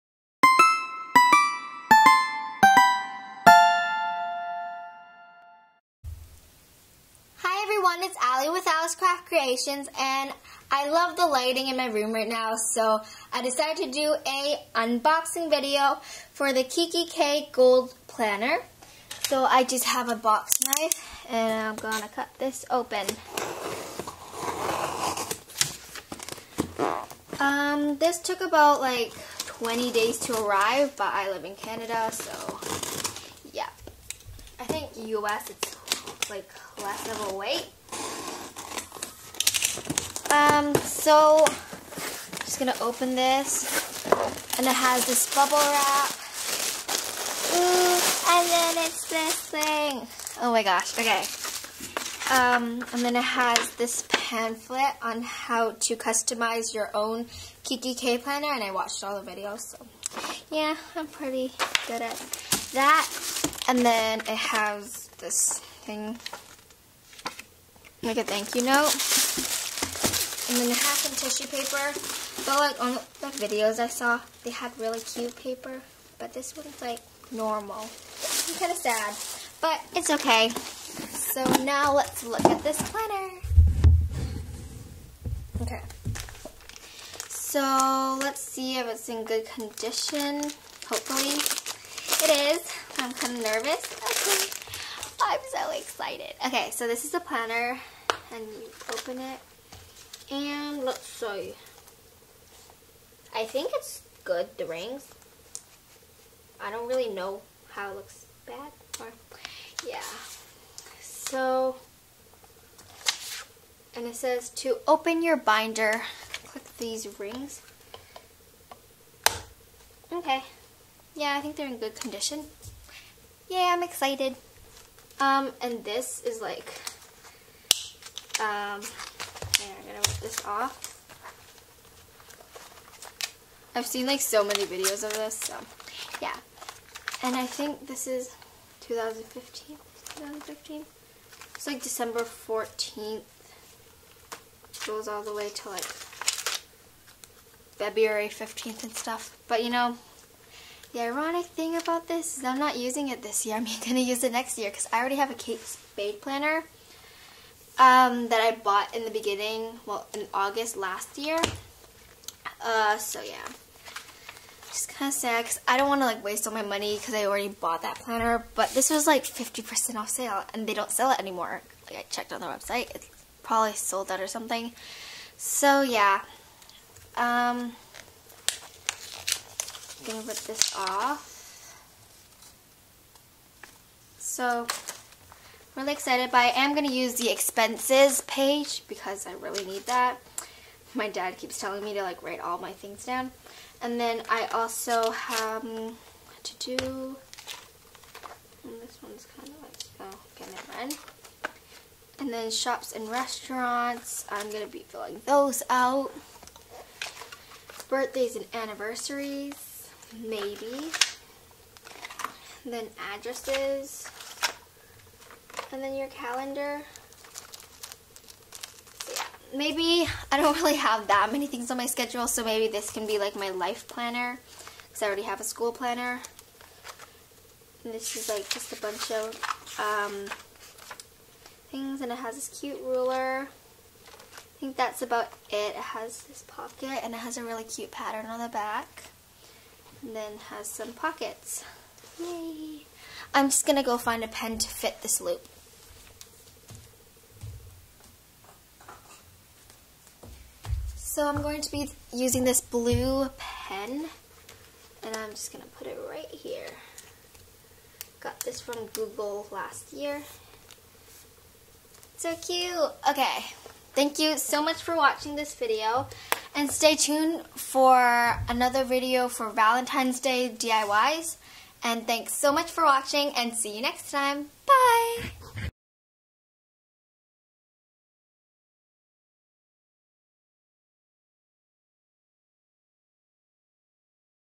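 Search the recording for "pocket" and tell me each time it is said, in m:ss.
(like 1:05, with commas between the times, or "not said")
3:56, 4:00.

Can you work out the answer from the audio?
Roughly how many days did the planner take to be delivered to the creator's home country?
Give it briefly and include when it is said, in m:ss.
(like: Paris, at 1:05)
20 days, at 0:29.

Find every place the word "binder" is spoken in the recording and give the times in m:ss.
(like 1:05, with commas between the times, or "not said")
1:55.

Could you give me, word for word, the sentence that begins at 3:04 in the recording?
So, really excited, but I am going to use the expenses page because I really need that.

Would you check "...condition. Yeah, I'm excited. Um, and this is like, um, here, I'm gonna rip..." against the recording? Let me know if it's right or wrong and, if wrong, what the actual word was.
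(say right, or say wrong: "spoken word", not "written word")
right.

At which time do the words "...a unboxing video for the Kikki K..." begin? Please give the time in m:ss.
0:14.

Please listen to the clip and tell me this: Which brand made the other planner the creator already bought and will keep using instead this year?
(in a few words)
Kate Spade.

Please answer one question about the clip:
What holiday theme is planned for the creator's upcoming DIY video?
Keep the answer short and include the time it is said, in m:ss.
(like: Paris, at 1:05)
Valentine's Day, at 4:29.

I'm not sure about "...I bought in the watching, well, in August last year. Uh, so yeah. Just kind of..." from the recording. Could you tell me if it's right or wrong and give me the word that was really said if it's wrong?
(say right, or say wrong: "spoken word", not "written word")
wrong: "beginning", not "watching".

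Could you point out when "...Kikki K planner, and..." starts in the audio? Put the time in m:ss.
0:57.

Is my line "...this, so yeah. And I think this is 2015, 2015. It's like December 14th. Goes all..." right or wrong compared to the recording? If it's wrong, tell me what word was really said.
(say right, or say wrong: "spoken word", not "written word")
right.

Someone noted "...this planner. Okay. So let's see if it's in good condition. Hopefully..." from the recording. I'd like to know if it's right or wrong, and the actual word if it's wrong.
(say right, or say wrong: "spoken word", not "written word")
right.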